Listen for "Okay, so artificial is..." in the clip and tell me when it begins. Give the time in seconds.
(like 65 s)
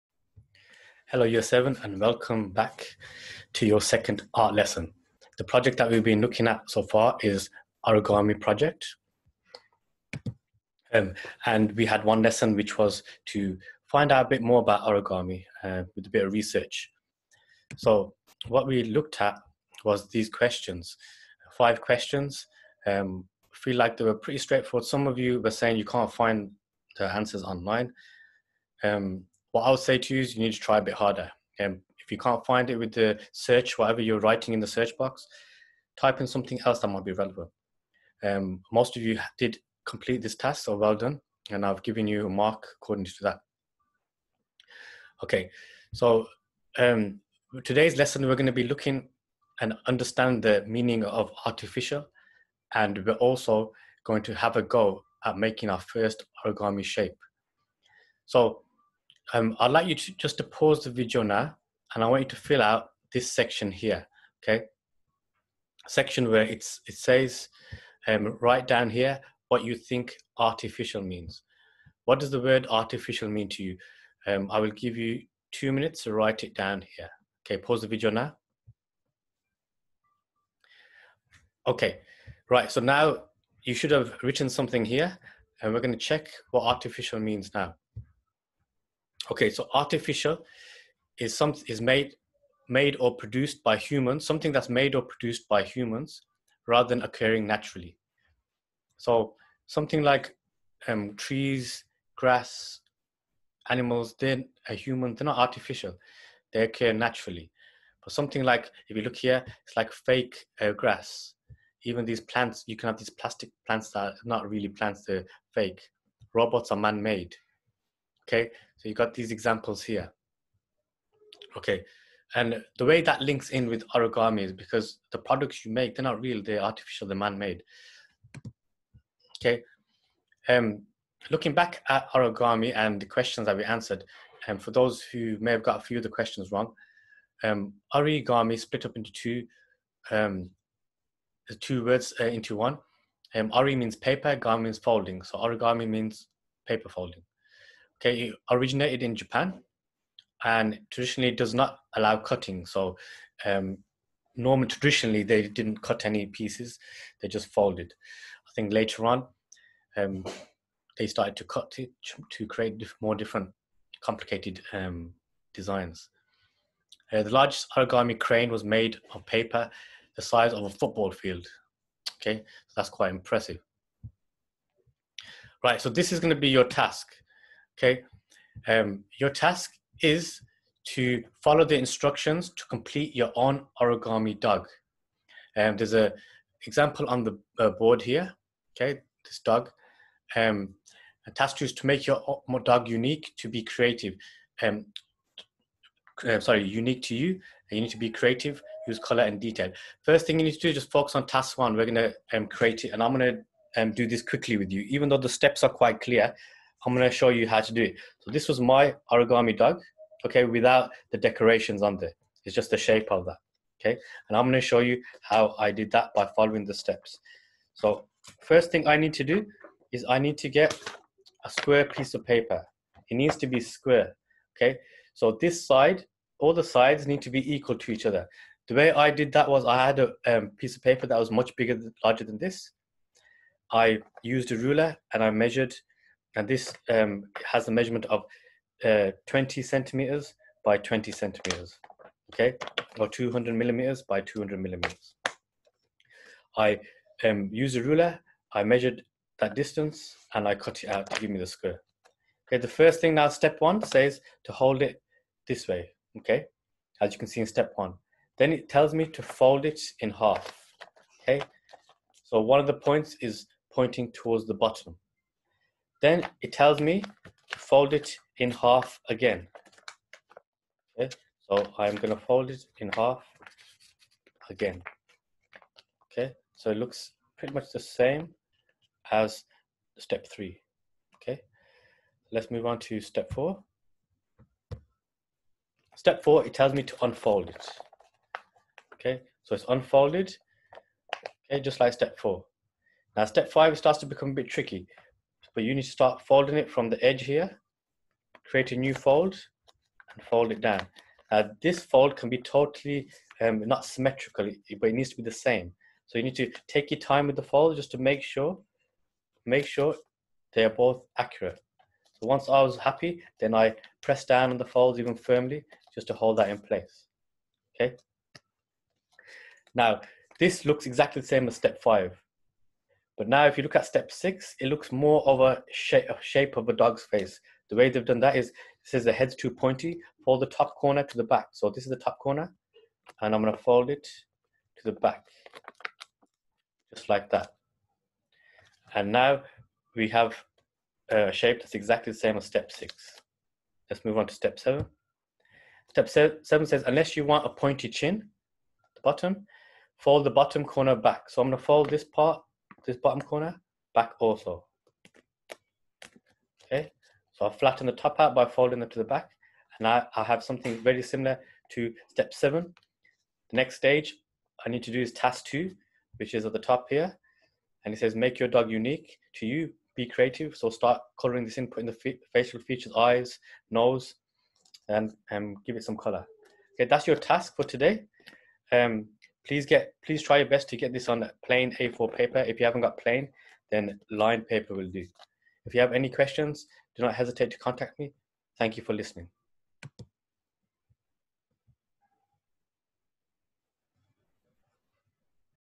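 89 s.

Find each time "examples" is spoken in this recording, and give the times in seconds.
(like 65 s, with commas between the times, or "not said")
119 s, 186 s.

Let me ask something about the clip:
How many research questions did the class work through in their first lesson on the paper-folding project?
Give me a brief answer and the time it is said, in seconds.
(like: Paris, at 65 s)
5, at 21 s.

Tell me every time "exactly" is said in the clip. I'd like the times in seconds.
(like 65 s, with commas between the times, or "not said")
320 s, 341 s.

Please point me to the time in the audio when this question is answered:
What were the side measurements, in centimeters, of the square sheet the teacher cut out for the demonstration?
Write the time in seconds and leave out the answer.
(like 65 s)
239 s.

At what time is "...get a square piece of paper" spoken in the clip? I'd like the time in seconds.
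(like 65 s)
220 s.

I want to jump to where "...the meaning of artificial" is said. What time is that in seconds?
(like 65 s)
50 s.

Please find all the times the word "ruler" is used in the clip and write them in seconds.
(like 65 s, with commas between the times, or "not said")
234 s, 247 s.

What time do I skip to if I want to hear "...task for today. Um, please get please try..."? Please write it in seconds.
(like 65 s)
377 s.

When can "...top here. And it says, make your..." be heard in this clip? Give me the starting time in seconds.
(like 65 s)
366 s.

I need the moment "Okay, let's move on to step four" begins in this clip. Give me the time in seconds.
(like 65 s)
281 s.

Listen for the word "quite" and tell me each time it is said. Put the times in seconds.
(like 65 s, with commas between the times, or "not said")
172 s, 205 s.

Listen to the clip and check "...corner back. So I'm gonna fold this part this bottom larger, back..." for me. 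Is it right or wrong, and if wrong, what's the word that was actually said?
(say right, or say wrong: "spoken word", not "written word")
wrong: "corner", not "larger".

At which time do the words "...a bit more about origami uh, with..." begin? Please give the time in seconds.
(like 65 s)
14 s.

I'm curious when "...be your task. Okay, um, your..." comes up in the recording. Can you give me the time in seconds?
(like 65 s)
176 s.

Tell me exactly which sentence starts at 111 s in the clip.
Even these plants, you can have these plastic plants that are not really plants, they're fake.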